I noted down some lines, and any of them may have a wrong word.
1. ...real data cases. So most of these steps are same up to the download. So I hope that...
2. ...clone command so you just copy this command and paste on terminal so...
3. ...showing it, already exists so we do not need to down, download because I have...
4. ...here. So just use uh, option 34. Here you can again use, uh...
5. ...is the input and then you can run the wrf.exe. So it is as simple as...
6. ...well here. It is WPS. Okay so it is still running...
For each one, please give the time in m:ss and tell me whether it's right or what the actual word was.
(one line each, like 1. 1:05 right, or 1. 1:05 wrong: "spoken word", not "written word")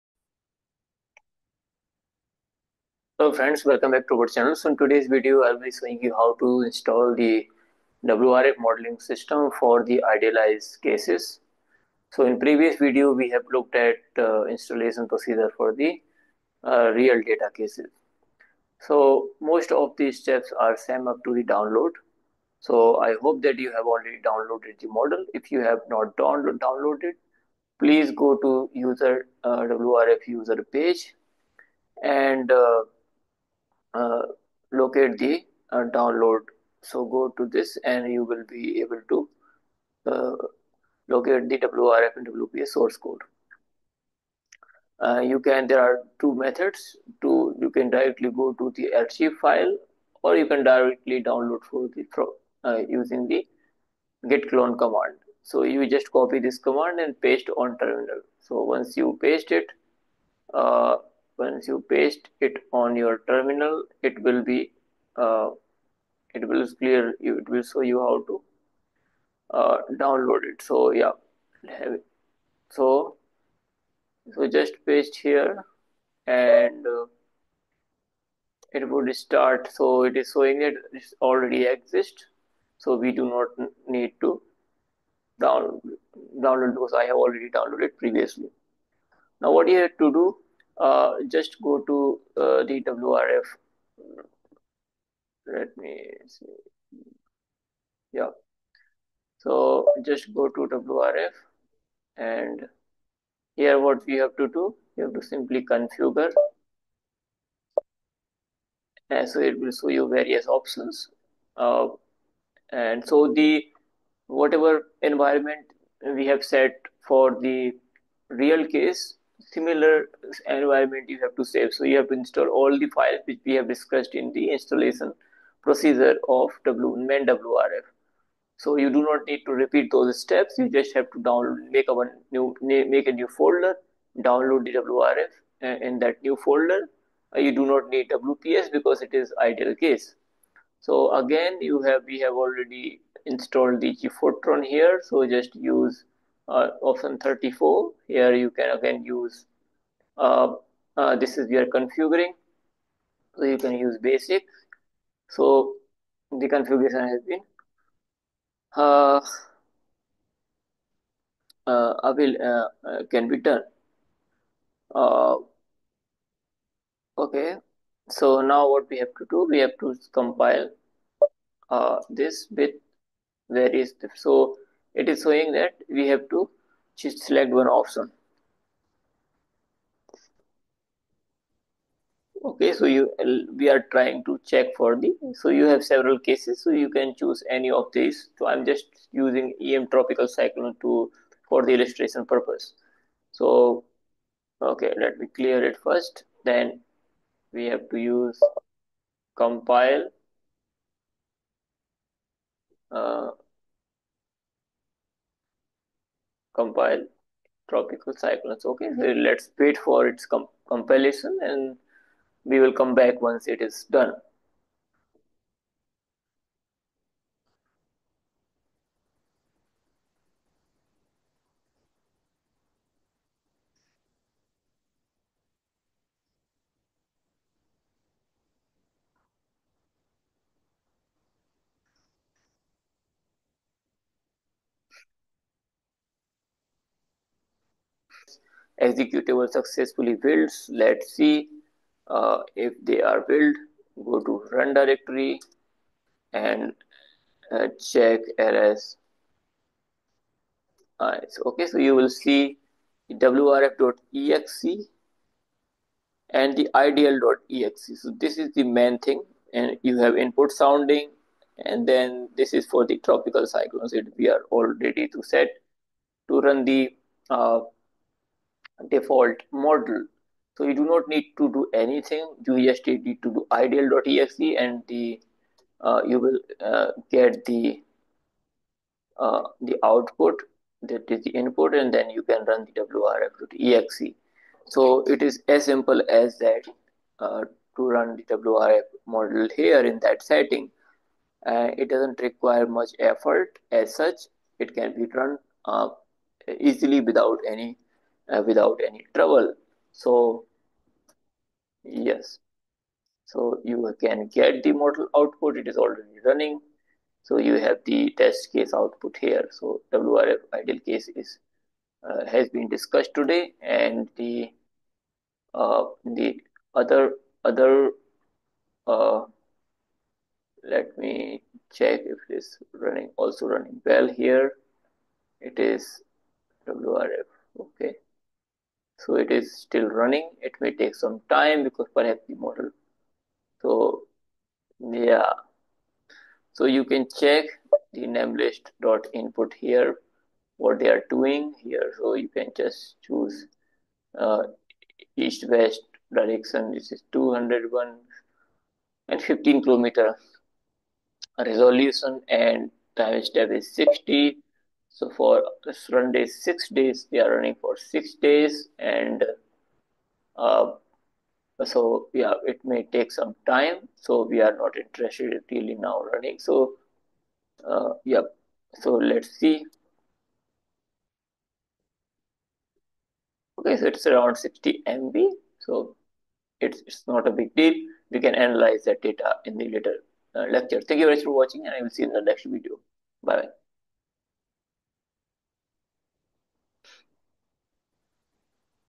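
1. 0:16 right
2. 0:54 right
3. 1:20 right
4. 2:24 right
5. 4:41 right
6. 5:23 wrong: "WRF", not "WPS".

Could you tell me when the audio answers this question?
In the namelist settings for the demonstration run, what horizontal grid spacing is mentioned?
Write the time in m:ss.
5:49.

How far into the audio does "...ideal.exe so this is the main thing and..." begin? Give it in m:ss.
4:16.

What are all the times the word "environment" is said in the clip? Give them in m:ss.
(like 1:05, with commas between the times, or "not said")
1:55, 2:00.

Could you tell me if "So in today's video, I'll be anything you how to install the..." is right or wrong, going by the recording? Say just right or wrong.
wrong.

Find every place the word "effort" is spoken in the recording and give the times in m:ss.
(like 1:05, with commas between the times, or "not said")
4:52.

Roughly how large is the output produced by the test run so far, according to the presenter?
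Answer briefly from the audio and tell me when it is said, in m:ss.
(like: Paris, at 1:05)
60 MB, at 6:14.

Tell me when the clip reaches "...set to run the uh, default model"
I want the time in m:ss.
4:25.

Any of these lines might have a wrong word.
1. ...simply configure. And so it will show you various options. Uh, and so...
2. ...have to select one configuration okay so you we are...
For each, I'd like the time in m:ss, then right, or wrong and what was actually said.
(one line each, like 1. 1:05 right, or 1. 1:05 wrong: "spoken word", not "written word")
1. 1:45 right
2. 2:56 wrong: "option", not "configuration".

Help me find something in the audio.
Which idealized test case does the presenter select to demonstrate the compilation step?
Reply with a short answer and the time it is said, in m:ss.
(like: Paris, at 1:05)
em tropical cyclone, at 3:09.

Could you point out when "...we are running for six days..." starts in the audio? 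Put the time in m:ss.
5:57.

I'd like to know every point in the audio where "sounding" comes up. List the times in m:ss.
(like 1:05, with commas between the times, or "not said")
4:20.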